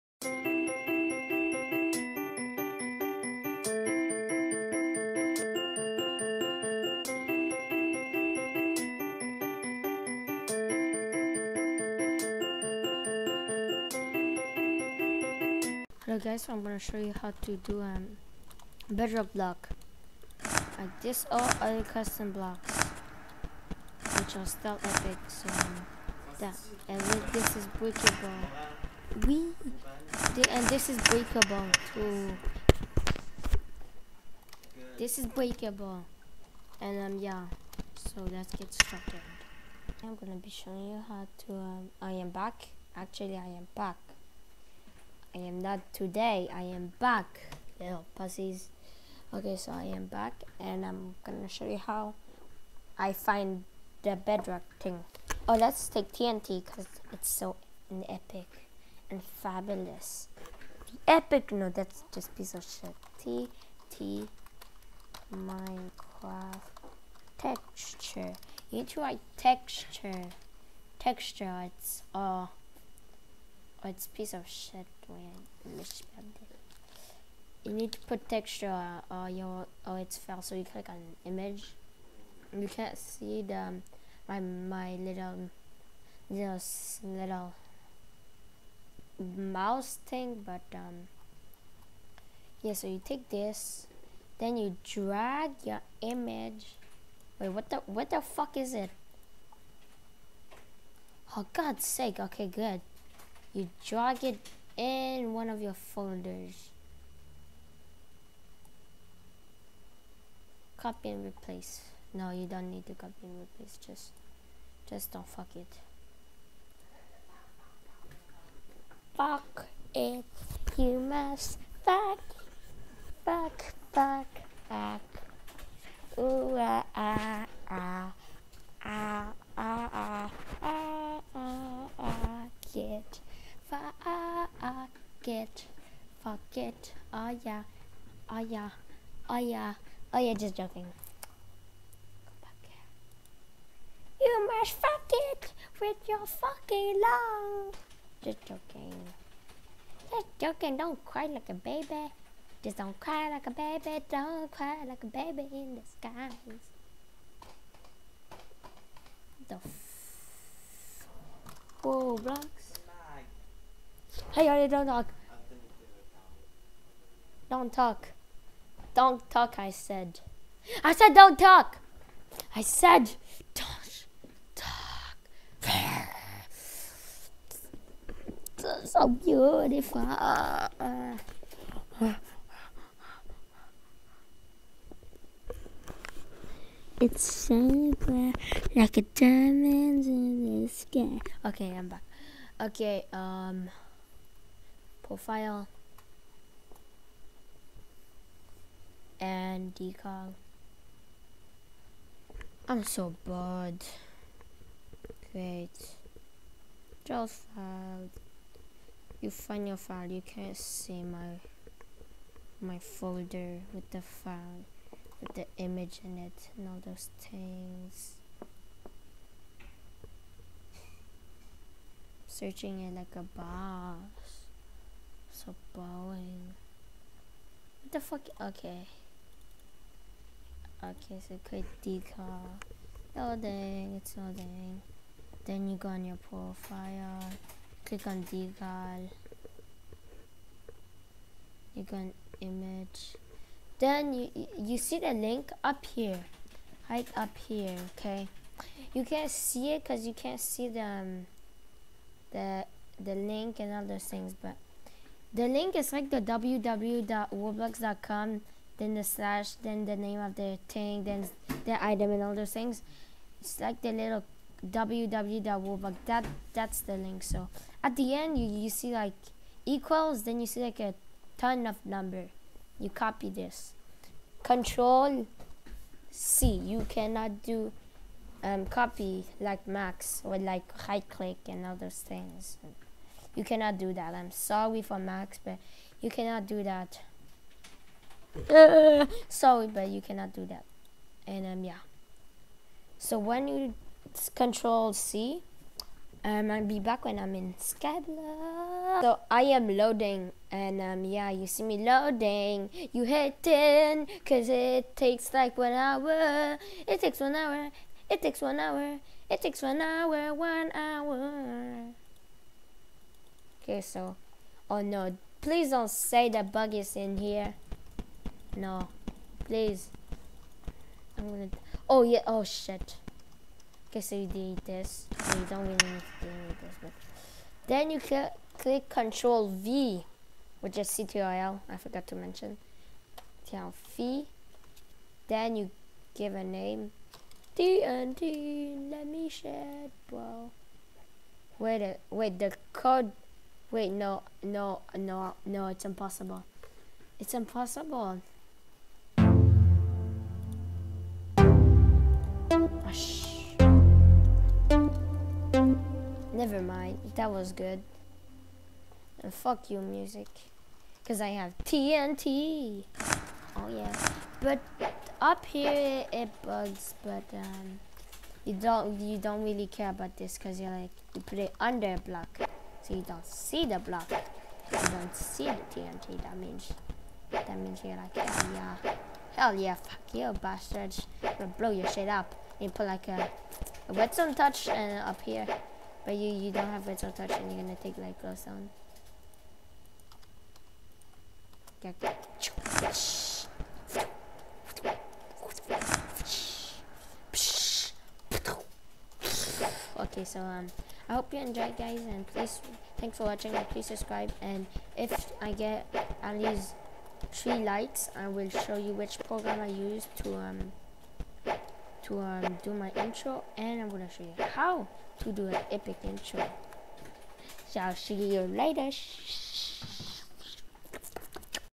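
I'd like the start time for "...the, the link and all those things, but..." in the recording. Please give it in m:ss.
4:12.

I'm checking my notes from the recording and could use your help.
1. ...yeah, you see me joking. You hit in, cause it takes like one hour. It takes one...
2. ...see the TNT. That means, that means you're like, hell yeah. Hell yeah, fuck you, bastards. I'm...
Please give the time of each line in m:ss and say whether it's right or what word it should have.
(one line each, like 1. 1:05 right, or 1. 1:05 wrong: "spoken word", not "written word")
1. 5:01 wrong: "loading", not "joking"
2. 6:15 right.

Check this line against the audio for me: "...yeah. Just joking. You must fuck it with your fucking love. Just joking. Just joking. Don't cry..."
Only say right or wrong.
right.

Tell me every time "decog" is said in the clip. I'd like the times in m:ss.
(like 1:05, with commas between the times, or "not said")
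3:19.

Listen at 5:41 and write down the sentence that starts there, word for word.
Wait, wait, the code Wait, no, no, no, no, it's impossible.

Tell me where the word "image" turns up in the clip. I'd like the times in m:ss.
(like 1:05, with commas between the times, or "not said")
1:21, 1:36, 3:35, 4:02.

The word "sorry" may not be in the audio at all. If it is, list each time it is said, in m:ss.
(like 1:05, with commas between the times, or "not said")
4:44, 4:49.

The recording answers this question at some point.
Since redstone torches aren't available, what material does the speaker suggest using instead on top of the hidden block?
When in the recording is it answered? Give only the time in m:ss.
6:27.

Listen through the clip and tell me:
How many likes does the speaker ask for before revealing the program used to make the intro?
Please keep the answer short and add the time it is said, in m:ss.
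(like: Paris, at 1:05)
3, at 6:46.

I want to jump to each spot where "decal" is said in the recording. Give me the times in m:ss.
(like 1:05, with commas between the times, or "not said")
3:51, 3:58.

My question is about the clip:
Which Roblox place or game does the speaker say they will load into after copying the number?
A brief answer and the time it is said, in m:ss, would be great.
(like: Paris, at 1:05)
Skyblox, at 4:56.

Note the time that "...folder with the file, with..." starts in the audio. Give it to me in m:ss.
3:32.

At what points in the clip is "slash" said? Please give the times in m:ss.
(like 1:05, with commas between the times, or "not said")
4:19.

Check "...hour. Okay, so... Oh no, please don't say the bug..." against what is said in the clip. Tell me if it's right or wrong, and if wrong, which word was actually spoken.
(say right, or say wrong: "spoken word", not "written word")
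right.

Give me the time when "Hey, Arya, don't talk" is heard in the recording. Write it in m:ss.
2:44.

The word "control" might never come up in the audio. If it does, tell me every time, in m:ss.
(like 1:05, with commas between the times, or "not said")
4:34, 4:54, 5:28, 5:33.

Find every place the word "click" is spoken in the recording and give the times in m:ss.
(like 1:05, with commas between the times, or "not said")
1:20, 3:57, 4:41, 5:28.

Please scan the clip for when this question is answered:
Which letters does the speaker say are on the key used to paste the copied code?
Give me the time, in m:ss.
5:30.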